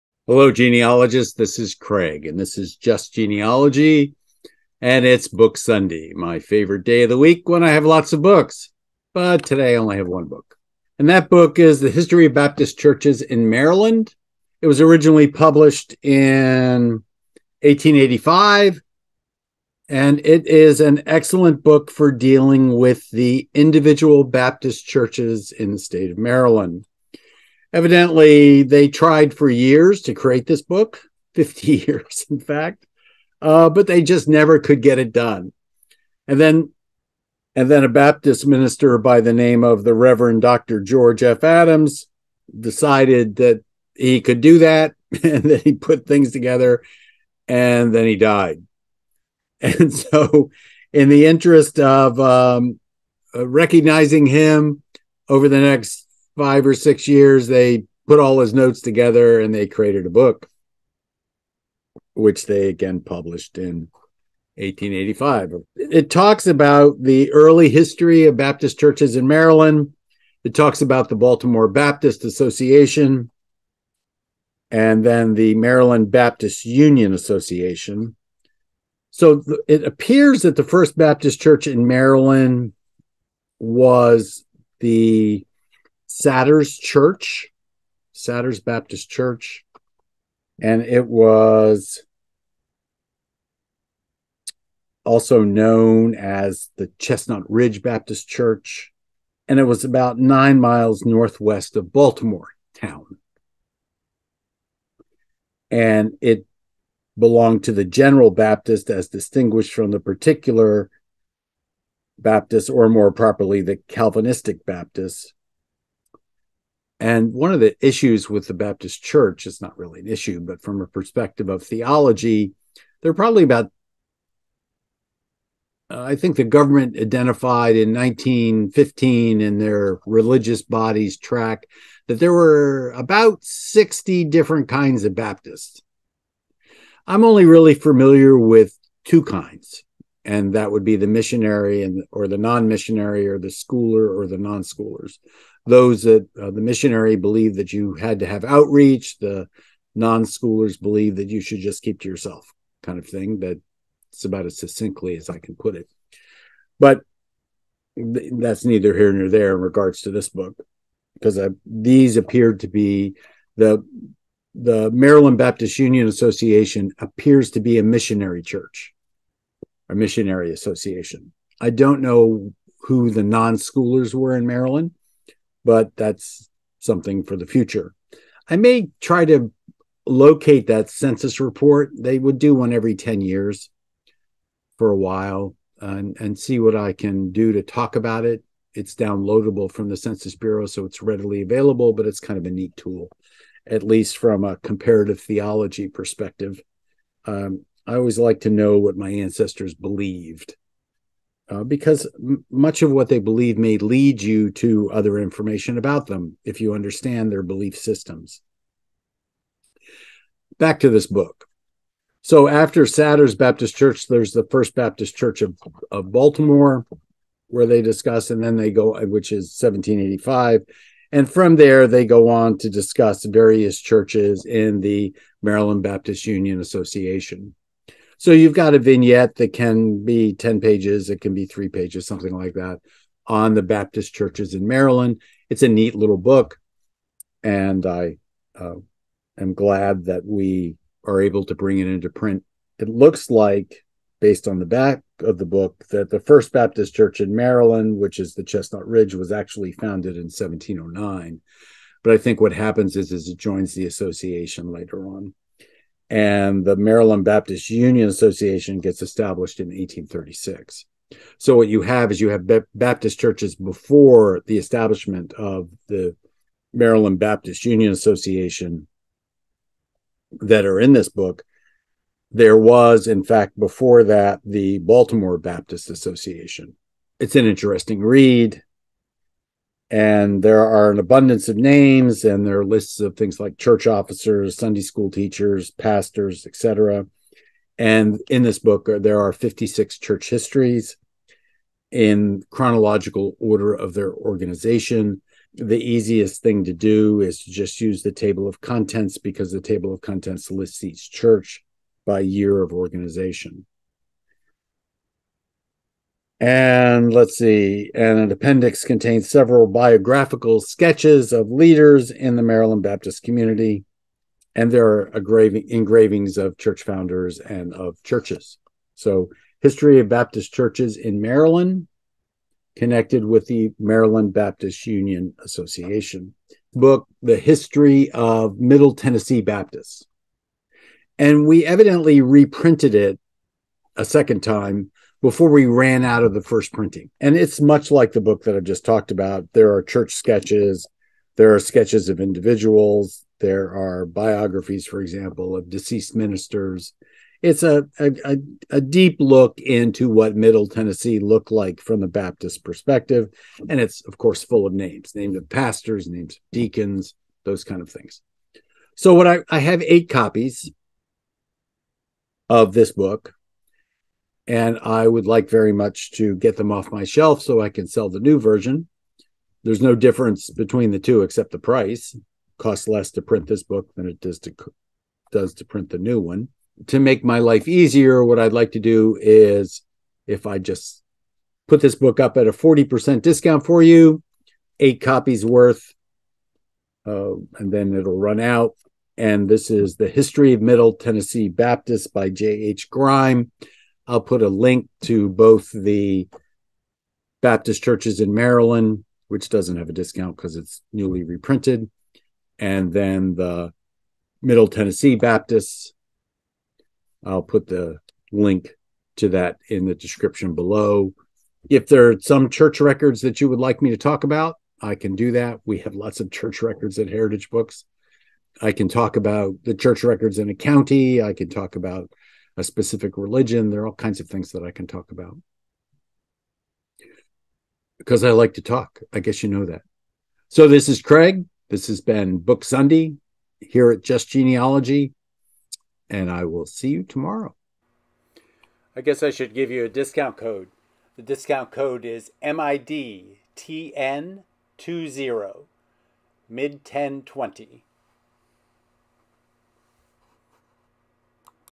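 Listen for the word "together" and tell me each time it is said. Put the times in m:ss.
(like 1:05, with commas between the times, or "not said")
0:46, 0:58.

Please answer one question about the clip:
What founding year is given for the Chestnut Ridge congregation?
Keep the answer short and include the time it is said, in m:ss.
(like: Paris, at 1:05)
1709, at 4:10.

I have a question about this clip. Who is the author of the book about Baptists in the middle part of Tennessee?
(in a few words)
J.H. Grime.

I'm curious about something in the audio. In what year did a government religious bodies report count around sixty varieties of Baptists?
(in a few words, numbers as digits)
1915.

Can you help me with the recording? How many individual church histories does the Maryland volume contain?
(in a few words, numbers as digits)
56.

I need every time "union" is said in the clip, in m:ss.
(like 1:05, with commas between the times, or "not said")
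1:16, 2:45, 3:46, 4:17, 4:27, 5:24.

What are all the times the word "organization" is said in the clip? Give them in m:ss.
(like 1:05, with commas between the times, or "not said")
4:54, 5:02.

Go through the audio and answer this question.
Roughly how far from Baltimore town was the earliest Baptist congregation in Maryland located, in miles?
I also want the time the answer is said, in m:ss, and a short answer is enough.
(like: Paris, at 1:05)
9 miles, at 1:40.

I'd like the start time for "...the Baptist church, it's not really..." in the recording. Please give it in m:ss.
1:58.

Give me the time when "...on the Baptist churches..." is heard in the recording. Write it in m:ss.
3:53.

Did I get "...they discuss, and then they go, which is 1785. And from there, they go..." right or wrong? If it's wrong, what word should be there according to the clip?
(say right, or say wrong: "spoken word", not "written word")
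right.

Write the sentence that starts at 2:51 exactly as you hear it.
I don't know who the non schoolers were in Maryland, but that's something for the future.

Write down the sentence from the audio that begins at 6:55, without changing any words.
We have lots of church records at Heritage Books.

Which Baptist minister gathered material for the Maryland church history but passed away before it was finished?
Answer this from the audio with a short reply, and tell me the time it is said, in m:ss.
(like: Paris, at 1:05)
George F. Adams, at 0:40.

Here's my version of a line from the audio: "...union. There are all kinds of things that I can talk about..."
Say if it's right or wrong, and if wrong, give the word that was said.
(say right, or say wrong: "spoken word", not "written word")
wrong: "religion", not "union".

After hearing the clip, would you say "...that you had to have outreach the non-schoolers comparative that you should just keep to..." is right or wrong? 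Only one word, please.
wrong.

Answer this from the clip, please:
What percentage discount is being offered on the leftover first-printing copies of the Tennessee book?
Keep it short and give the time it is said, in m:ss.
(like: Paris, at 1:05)
40%, at 6:22.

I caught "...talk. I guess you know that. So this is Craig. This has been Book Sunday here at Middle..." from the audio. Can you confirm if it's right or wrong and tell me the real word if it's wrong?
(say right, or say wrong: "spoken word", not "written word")
wrong: "Just", not "Middle".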